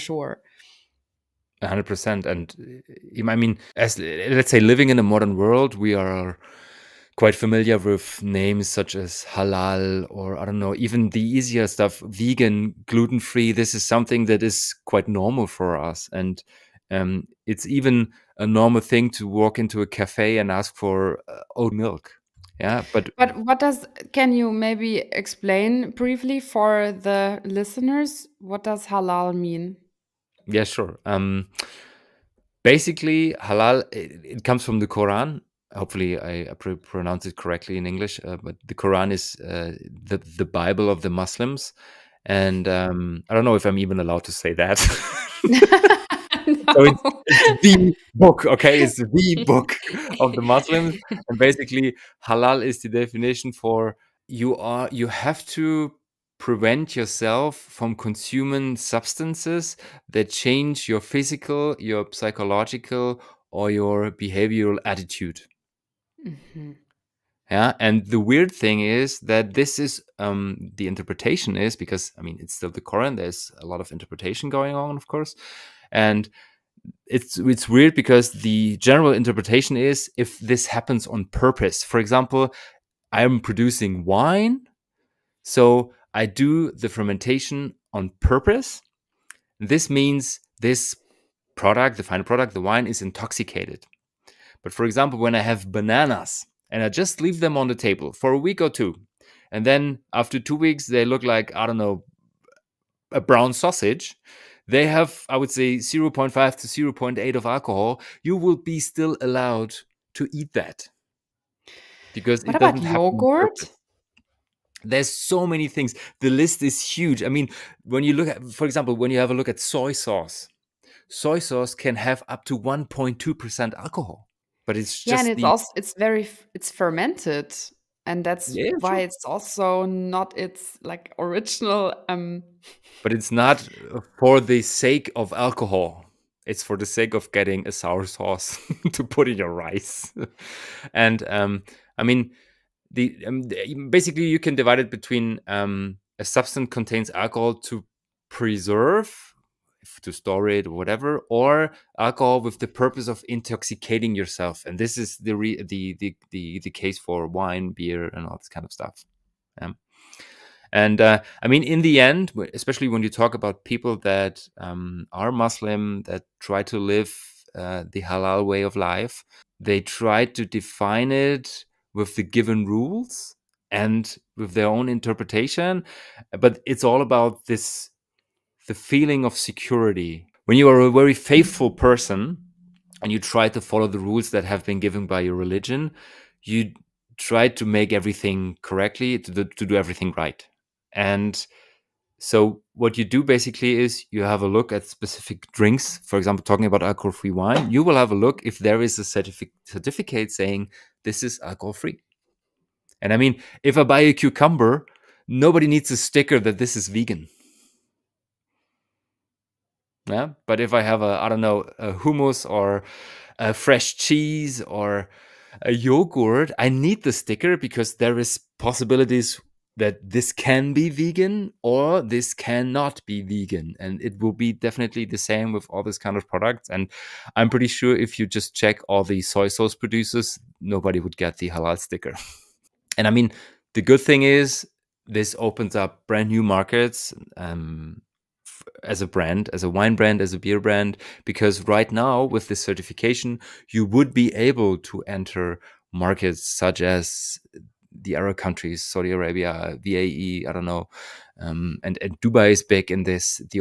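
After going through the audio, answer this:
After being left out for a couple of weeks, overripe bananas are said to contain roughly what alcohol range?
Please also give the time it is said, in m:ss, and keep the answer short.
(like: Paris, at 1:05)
0.5 to 0.8, at 1:45.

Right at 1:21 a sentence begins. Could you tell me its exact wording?
For example, I am producing wine, so I do the fermentation on purpose.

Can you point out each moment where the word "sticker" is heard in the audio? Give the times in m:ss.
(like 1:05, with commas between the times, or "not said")
3:25, 3:37, 3:51.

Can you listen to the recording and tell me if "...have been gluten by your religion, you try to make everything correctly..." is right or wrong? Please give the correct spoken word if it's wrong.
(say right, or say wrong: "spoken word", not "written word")
wrong: "given", not "gluten".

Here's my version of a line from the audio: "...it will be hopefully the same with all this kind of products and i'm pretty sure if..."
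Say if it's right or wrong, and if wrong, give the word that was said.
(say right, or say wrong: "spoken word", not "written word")
wrong: "definitely", not "hopefully".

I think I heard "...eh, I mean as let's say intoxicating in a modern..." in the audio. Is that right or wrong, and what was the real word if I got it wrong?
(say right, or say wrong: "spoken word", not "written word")
wrong: "living", not "intoxicating".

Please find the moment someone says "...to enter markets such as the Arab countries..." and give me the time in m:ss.
4:04.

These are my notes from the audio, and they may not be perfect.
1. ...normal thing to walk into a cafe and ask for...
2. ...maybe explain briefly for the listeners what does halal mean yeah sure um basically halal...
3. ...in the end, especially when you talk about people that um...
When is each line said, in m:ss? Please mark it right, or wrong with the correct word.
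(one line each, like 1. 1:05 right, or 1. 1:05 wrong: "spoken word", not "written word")
1. 0:18 right
2. 0:24 right
3. 2:41 right.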